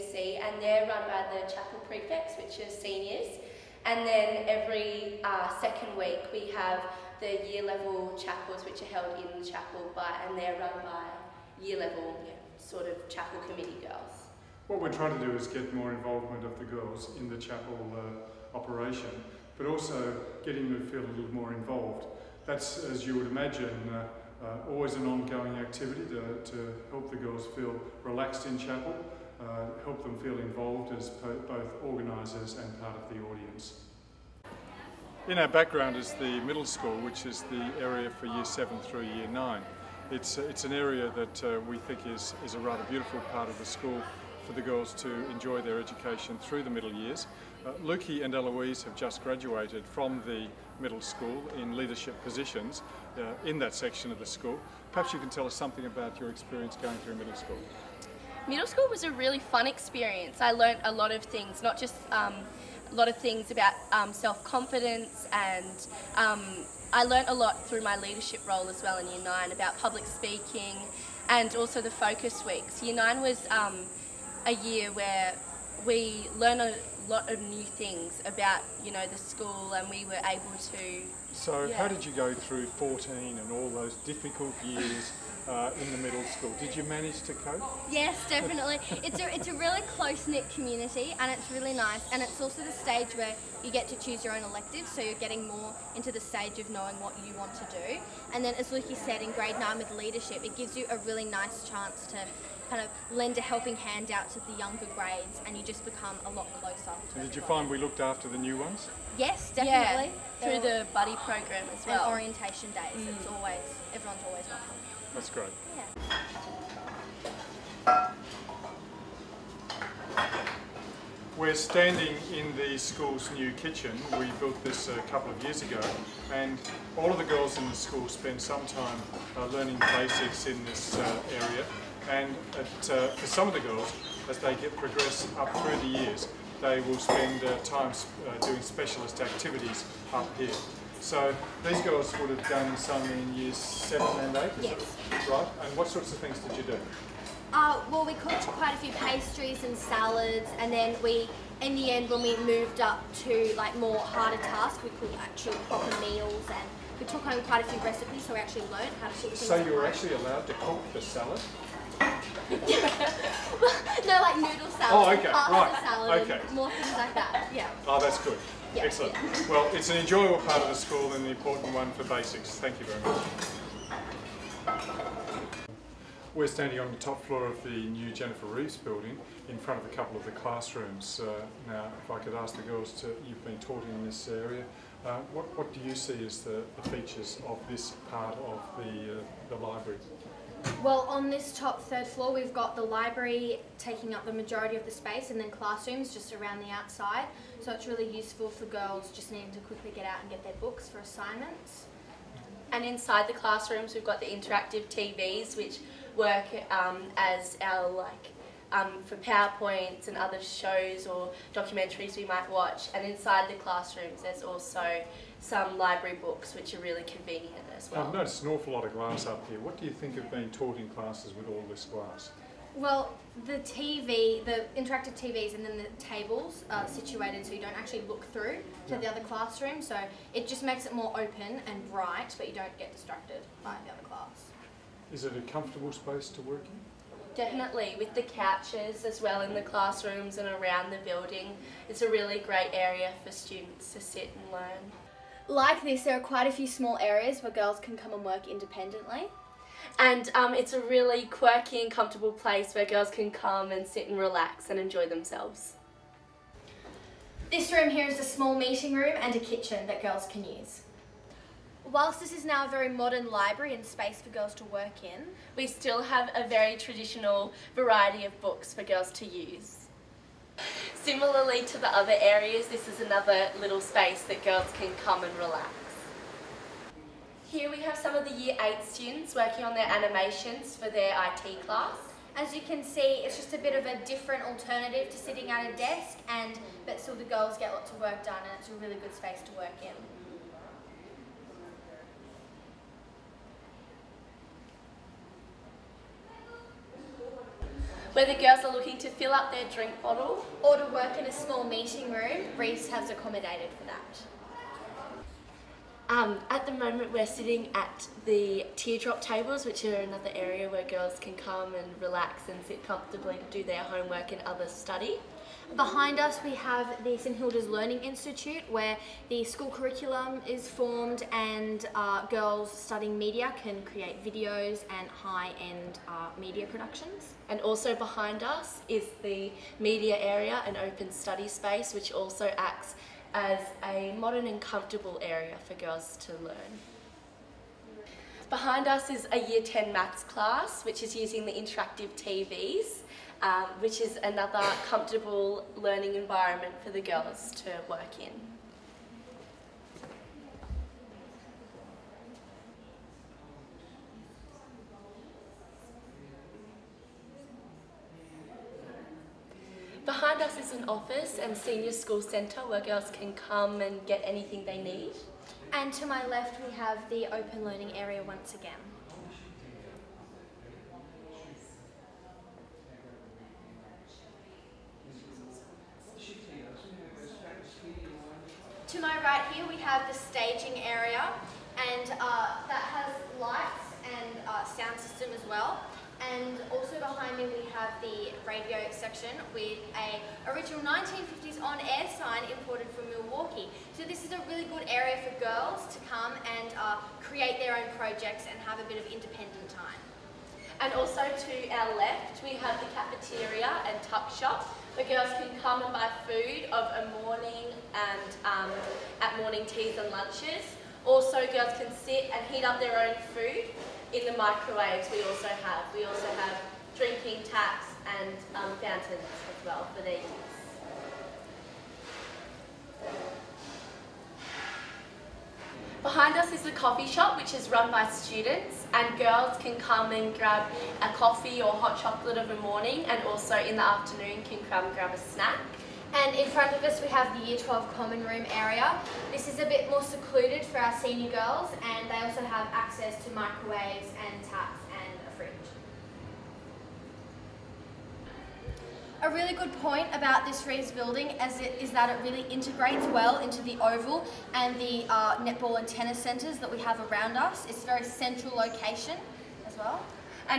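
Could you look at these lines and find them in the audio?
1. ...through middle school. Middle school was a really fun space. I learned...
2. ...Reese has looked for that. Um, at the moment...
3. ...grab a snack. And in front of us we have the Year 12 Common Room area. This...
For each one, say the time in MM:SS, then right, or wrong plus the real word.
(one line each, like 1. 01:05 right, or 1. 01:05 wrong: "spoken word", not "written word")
1. 00:56 wrong: "experience", not "space"
2. 05:02 wrong: "accommodated", not "looked"
3. 07:14 right.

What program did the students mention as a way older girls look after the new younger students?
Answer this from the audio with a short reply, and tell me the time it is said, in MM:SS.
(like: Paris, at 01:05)
buddy program, at 01:50.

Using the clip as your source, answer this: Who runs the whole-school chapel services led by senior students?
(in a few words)
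chapel prefects.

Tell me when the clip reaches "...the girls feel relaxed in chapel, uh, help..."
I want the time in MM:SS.
00:27.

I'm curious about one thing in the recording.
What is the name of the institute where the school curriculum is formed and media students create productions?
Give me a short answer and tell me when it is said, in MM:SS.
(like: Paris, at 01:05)
St Hilda's Learning Institute, at 05:17.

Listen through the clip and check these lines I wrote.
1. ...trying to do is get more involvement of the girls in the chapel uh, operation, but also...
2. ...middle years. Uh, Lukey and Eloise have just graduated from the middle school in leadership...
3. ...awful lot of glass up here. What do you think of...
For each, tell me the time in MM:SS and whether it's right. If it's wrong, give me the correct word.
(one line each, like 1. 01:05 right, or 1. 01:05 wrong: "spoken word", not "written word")
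1. 00:14 right
2. 00:46 right
3. 03:38 right.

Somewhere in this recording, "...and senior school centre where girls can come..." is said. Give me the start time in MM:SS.
06:01.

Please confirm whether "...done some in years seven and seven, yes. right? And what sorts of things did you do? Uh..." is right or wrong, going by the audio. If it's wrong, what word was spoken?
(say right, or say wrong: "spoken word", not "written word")
wrong: "eight", not "seven".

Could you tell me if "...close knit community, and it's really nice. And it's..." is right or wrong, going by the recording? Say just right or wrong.
right.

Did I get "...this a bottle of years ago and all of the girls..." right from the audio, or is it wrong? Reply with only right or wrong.
wrong.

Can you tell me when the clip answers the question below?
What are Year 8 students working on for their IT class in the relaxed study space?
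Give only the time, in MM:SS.
04:39.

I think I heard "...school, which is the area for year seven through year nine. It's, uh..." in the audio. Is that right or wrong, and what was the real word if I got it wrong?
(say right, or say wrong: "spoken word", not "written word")
right.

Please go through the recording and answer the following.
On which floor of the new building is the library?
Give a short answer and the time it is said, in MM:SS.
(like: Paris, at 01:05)
third floor, at 03:11.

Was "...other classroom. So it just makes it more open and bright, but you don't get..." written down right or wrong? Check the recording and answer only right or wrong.
right.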